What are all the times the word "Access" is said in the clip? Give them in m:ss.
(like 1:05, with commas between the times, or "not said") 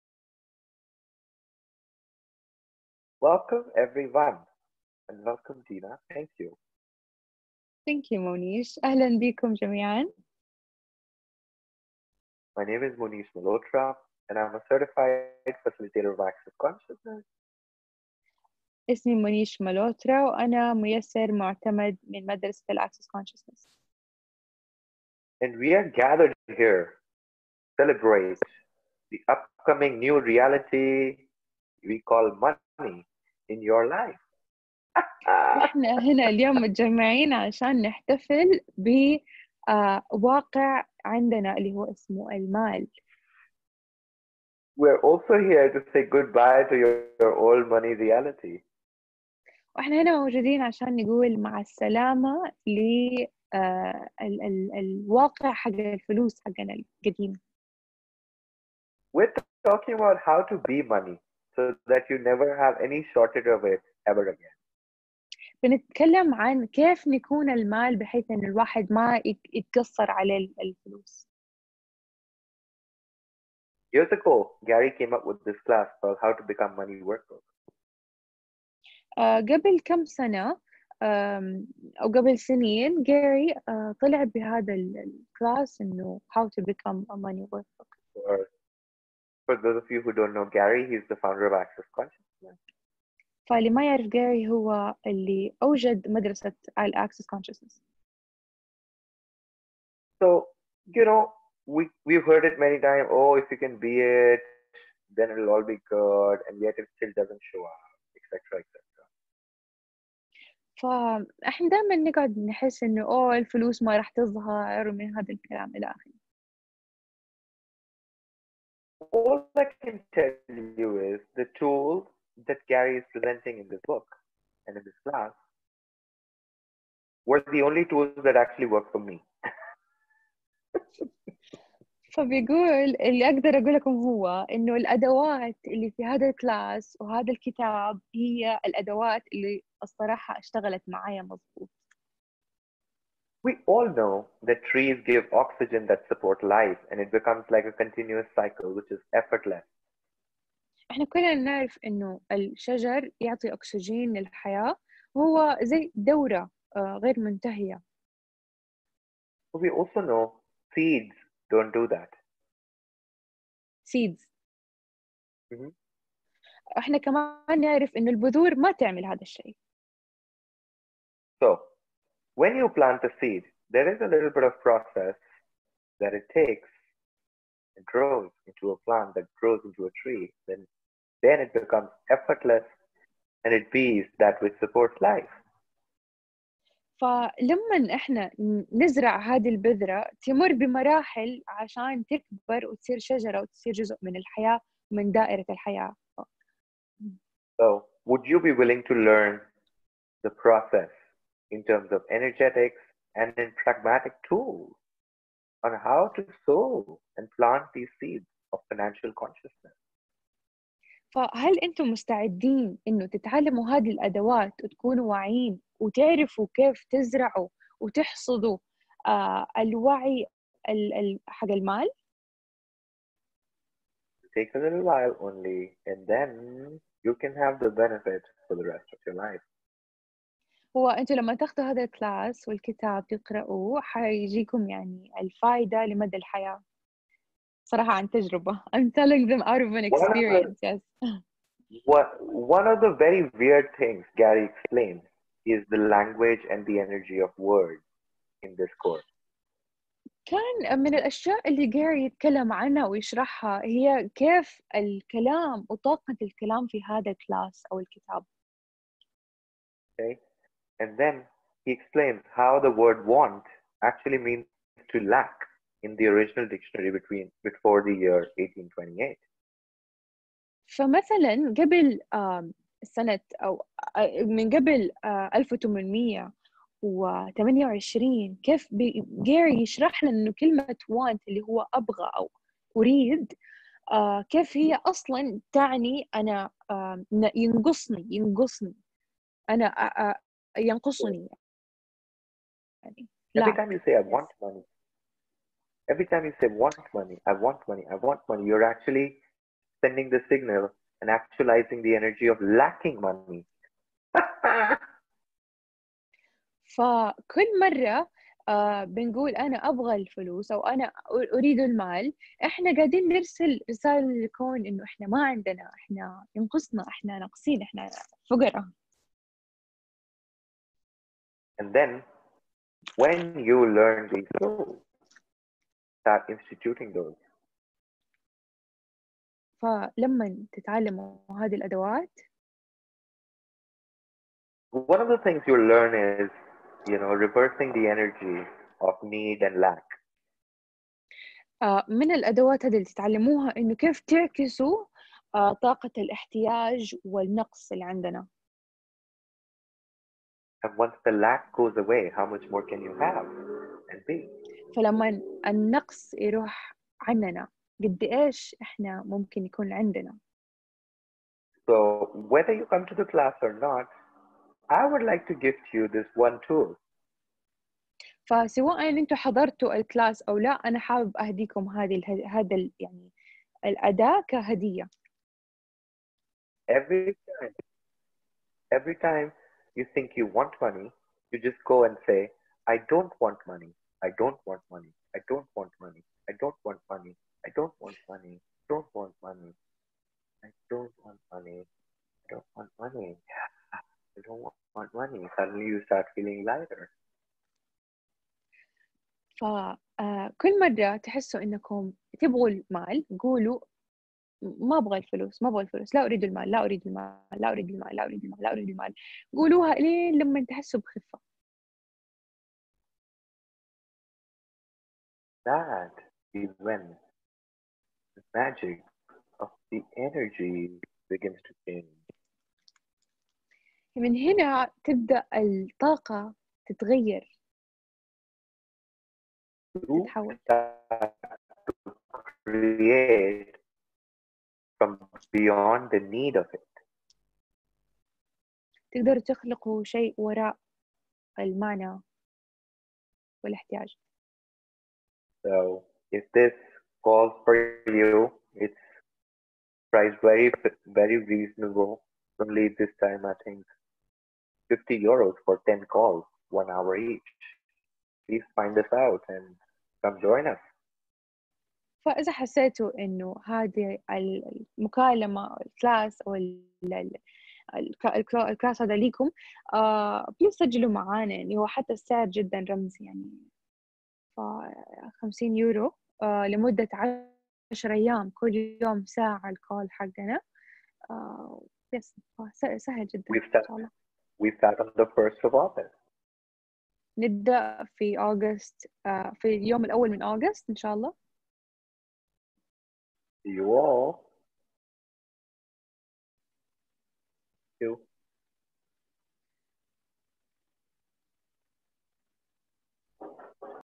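0:16, 0:22, 1:31, 1:36.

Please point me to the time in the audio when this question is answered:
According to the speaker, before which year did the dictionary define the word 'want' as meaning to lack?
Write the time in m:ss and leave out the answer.
4:27.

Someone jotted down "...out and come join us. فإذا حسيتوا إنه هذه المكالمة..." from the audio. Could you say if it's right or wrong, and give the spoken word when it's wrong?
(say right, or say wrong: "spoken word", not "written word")
right.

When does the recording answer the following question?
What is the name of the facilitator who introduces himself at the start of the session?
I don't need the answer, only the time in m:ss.
0:12.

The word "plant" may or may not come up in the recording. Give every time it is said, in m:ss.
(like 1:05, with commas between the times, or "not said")
2:52, 2:58, 3:27.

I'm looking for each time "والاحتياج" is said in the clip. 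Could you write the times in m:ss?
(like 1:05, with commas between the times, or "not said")
7:23.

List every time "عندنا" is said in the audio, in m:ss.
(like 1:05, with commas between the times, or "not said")
0:41, 5:15, 5:47, 5:59.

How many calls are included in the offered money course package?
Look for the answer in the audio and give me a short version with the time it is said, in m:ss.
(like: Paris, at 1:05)
10, at 7:35.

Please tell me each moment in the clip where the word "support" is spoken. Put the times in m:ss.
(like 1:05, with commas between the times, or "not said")
2:26, 3:04.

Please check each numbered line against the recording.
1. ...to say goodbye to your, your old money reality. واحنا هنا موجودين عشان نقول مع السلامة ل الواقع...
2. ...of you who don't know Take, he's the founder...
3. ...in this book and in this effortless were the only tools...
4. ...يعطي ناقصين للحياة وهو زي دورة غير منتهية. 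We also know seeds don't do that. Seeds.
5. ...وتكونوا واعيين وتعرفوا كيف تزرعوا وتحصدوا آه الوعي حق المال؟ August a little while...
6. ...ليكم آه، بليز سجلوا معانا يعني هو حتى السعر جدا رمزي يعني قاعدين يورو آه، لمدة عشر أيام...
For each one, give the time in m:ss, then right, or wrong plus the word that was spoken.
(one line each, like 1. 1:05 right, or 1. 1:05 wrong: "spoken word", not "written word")
1. 0:45 right
2. 1:29 wrong: "Gary", not "Take"
3. 2:03 wrong: "class", not "effortless"
4. 2:33 wrong: "اكسجين", not "ناقصين"
5. 3:34 wrong: "Take", not "August"
6. 7:48 wrong: "خمسين", not "قاعدين".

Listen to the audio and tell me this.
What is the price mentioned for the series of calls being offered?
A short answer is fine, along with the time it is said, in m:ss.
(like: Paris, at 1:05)
50 euros, at 7:34.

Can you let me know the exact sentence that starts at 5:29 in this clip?
فلما تتعلموا هذه الأدوات One of the things you learn is, you know, reversing the energy of need and lack.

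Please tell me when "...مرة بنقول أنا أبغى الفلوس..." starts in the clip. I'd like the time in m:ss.
5:07.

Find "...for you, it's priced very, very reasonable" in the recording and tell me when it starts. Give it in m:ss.
7:27.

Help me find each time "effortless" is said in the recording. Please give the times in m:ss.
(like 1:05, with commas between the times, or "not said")
2:29, 3:02.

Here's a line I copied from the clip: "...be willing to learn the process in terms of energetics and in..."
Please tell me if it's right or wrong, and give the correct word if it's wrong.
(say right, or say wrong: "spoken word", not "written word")
right.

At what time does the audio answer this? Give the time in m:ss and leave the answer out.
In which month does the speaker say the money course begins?
8:05.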